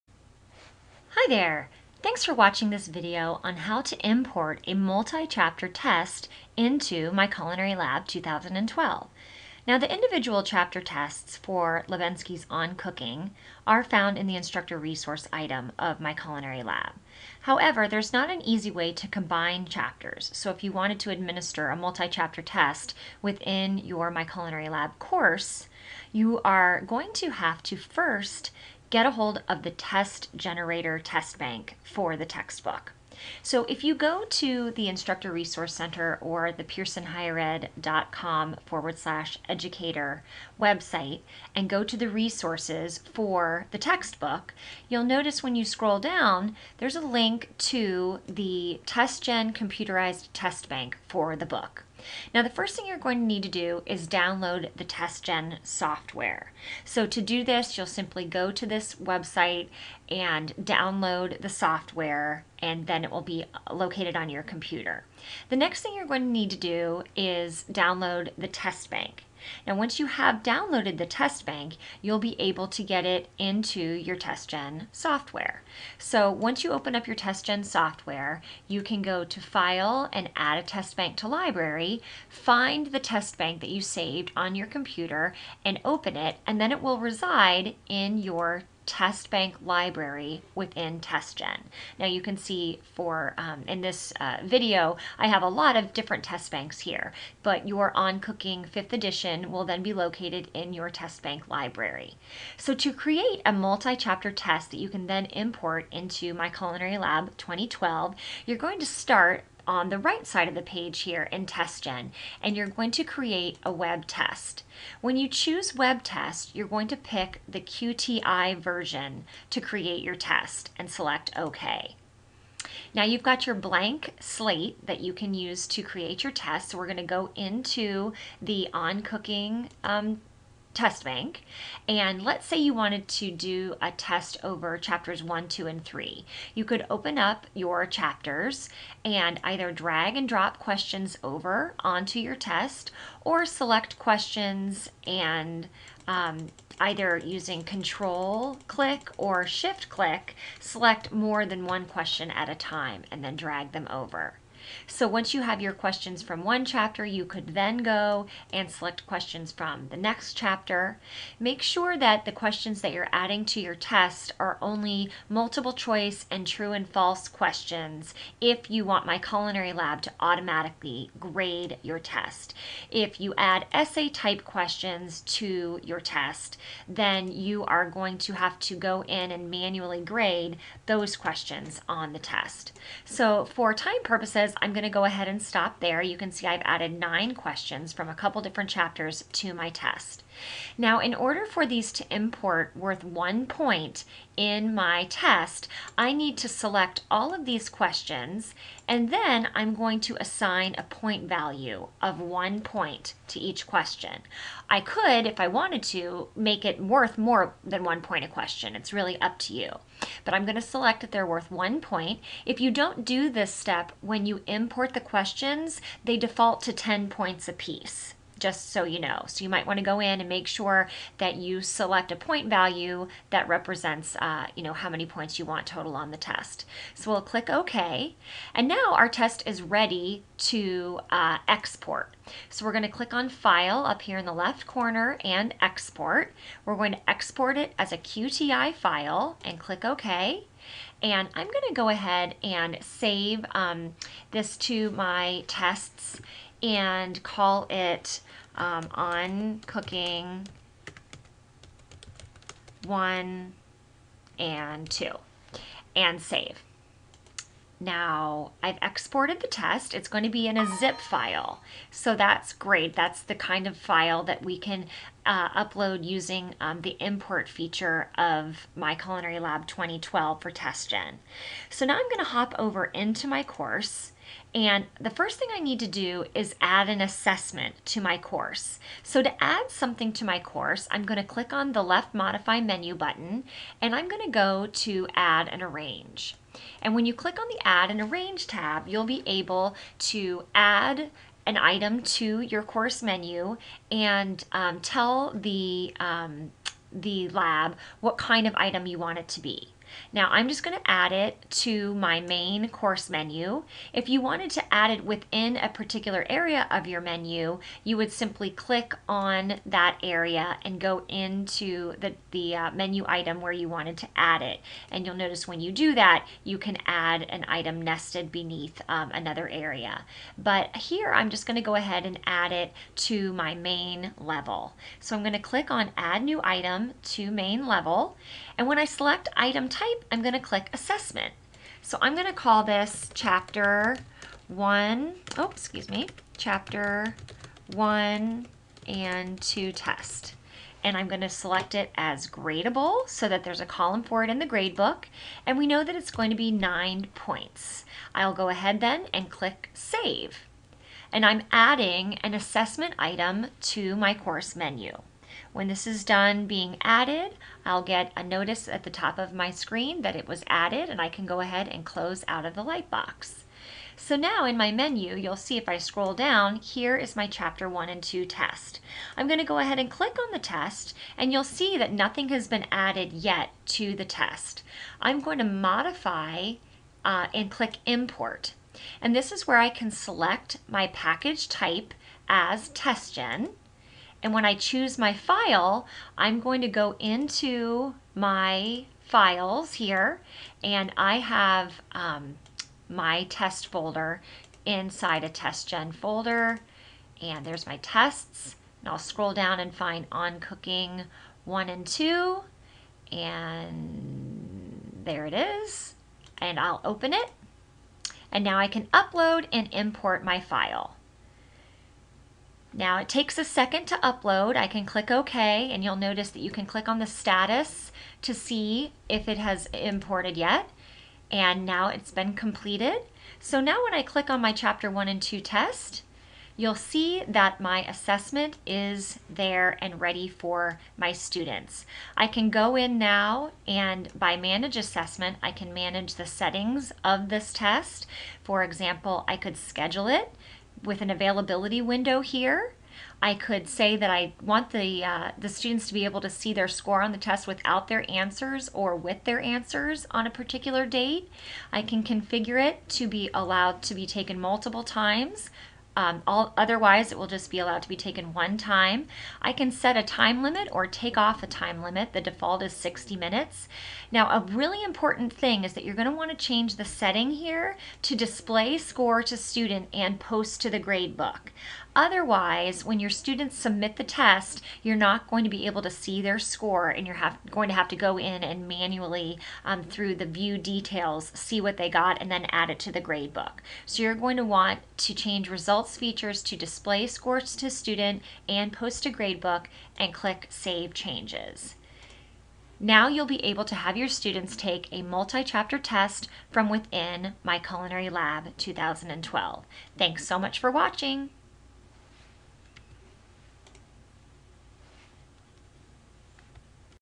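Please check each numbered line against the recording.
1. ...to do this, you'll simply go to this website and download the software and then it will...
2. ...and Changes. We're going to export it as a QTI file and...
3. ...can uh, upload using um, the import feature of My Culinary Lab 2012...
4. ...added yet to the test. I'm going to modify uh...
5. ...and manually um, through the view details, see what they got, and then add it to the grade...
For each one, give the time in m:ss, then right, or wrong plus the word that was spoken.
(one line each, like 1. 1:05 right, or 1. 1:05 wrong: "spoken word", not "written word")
1. 0:57 right
2. 3:55 wrong: "Export", not "Changes"
3. 4:24 right
4. 6:12 right
5. 7:58 right.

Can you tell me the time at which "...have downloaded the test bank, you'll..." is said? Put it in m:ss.
1:10.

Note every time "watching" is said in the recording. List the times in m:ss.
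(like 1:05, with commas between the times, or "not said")
0:02, 8:20.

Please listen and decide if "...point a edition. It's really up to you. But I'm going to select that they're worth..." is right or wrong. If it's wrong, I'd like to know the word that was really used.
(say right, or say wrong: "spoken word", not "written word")
wrong: "question", not "edition".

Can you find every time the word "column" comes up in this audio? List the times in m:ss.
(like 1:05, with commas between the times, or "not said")
5:43.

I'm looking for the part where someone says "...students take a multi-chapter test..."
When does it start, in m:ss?
8:14.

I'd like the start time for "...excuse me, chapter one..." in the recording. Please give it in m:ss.
5:35.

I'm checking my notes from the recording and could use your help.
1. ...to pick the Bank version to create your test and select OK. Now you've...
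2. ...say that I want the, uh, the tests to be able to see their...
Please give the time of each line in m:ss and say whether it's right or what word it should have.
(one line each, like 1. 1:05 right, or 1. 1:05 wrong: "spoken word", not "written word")
1. 1:56 wrong: "QTI", not "Bank"
2. 7:23 wrong: "students", not "tests".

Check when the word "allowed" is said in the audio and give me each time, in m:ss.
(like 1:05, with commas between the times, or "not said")
7:33, 7:37.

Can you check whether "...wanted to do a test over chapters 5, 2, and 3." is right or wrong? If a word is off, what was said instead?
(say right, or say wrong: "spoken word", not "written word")
wrong: "1", not "5".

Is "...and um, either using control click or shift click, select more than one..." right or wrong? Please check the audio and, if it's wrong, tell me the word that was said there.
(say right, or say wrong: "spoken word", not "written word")
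right.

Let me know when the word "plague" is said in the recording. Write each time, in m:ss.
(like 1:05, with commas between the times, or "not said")
not said.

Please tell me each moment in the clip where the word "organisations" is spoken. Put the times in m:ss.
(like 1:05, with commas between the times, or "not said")
not said.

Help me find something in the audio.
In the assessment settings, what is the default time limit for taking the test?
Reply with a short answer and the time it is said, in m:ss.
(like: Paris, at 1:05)
60 minutes, at 7:42.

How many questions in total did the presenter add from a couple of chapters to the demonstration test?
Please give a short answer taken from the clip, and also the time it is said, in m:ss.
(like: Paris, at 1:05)
9, at 3:06.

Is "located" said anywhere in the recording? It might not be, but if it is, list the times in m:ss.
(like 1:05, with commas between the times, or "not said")
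1:03, 1:39.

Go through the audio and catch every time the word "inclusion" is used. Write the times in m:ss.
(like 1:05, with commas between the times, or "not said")
not said.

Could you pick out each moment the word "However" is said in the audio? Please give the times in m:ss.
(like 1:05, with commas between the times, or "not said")
0:17.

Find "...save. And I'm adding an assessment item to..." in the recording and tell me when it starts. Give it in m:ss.
5:49.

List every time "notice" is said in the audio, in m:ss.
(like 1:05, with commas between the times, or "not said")
0:45, 5:15, 5:58, 6:55.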